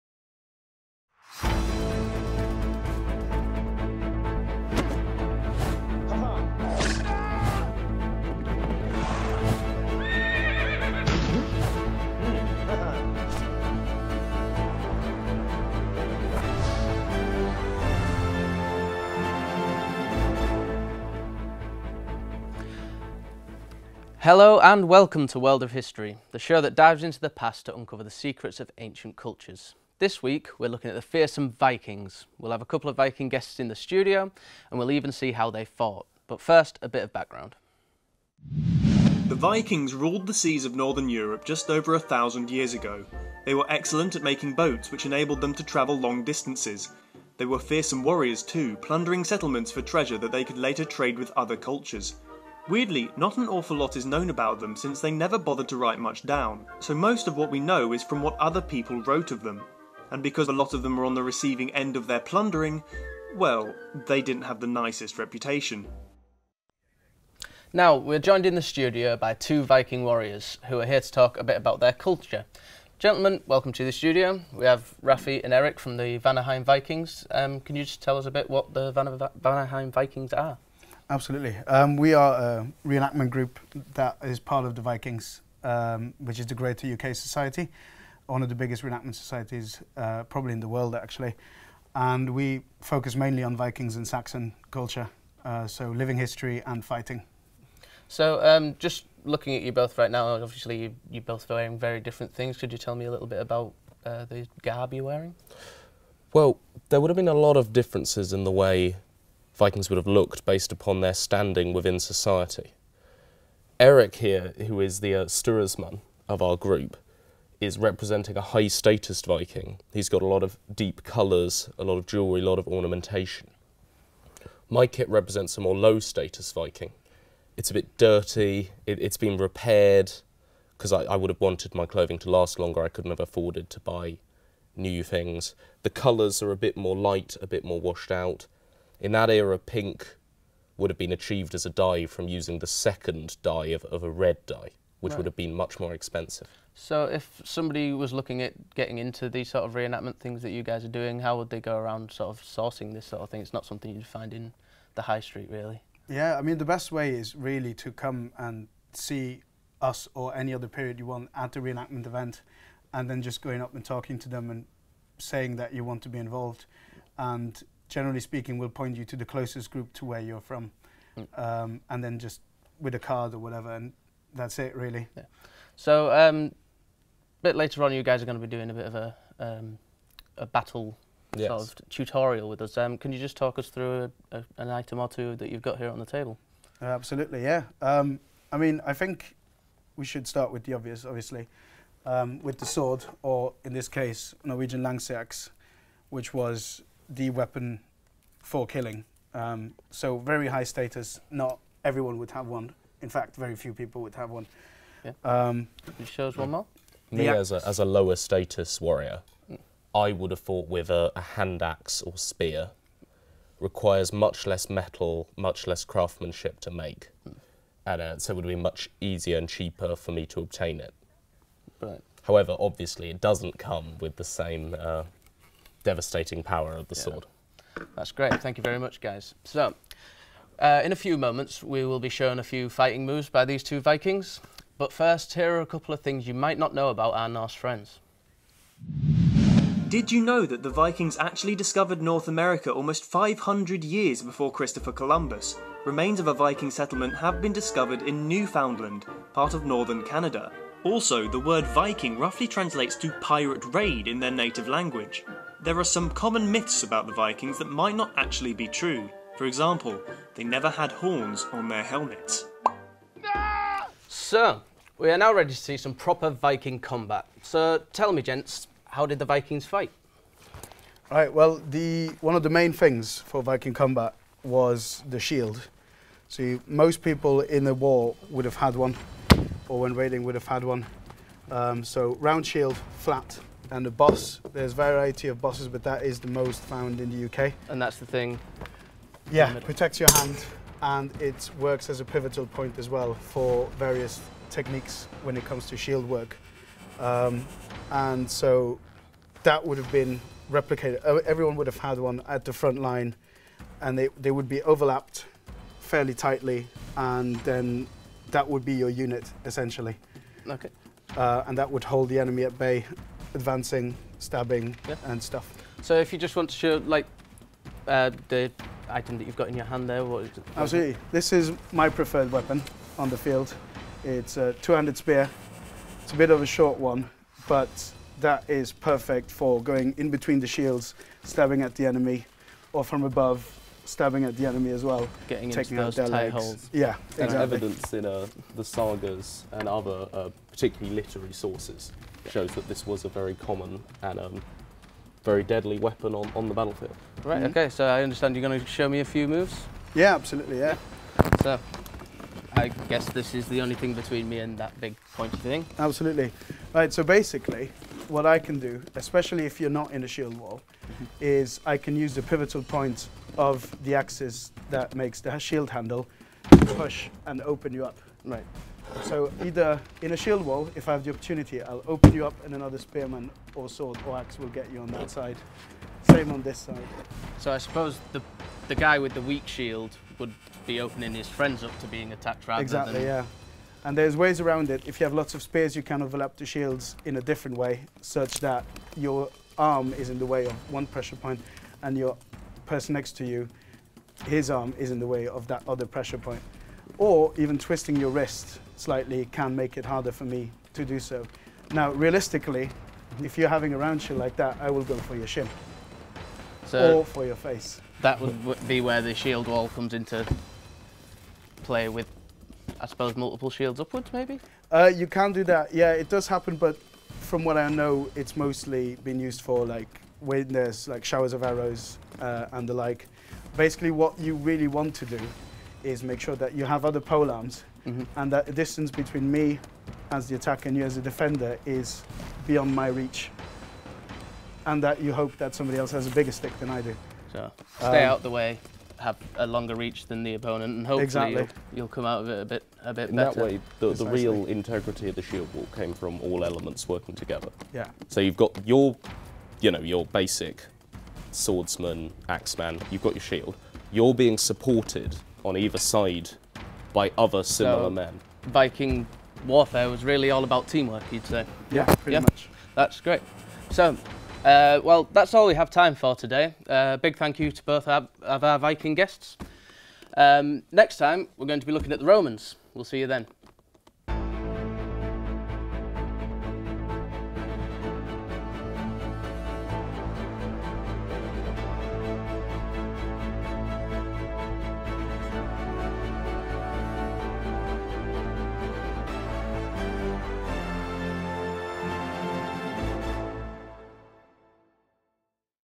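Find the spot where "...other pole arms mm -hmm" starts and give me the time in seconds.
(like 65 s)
426 s.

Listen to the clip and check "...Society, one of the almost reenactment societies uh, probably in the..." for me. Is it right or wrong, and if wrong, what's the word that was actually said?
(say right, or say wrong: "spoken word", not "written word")
wrong: "biggest", not "almost".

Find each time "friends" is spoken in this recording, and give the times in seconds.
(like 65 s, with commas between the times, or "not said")
237 s, 381 s.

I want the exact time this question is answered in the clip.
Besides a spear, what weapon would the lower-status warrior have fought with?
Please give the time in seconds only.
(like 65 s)
211 s.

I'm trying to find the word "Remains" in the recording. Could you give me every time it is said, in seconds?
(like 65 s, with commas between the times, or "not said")
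245 s.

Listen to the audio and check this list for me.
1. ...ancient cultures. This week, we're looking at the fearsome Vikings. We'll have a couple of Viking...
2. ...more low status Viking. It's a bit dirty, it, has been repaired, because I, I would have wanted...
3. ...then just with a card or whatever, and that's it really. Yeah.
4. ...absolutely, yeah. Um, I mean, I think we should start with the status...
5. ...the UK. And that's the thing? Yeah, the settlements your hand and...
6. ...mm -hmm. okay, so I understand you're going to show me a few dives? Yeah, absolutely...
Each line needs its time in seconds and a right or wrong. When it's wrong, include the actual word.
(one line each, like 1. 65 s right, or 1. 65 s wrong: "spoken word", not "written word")
1. 28 s right
2. 125 s right
3. 172 s right
4. 186 s wrong: "obvious", not "status"
5. 287 s wrong: "protects", not "settlements"
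6. 347 s wrong: "moves", not "dives".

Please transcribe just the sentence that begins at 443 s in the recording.
In that way, the, the real integrity of the shield wall came from all elements working together.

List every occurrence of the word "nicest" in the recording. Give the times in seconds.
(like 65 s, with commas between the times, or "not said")
64 s.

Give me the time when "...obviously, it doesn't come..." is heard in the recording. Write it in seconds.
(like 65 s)
222 s.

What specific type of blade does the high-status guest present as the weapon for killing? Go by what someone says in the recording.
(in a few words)
Norwegian Langsax.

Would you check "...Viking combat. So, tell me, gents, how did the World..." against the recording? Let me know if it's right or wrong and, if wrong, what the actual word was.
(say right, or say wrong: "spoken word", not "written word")
wrong: "Vikings", not "World".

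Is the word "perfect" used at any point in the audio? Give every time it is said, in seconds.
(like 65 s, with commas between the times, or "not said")
328 s.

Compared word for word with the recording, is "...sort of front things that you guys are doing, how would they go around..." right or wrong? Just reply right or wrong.
wrong.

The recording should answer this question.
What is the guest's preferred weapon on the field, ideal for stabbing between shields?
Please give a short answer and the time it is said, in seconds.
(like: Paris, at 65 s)
two-handed spear, at 324 s.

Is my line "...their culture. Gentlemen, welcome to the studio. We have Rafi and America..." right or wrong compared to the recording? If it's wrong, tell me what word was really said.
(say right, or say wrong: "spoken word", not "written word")
wrong: "Eric", not "America".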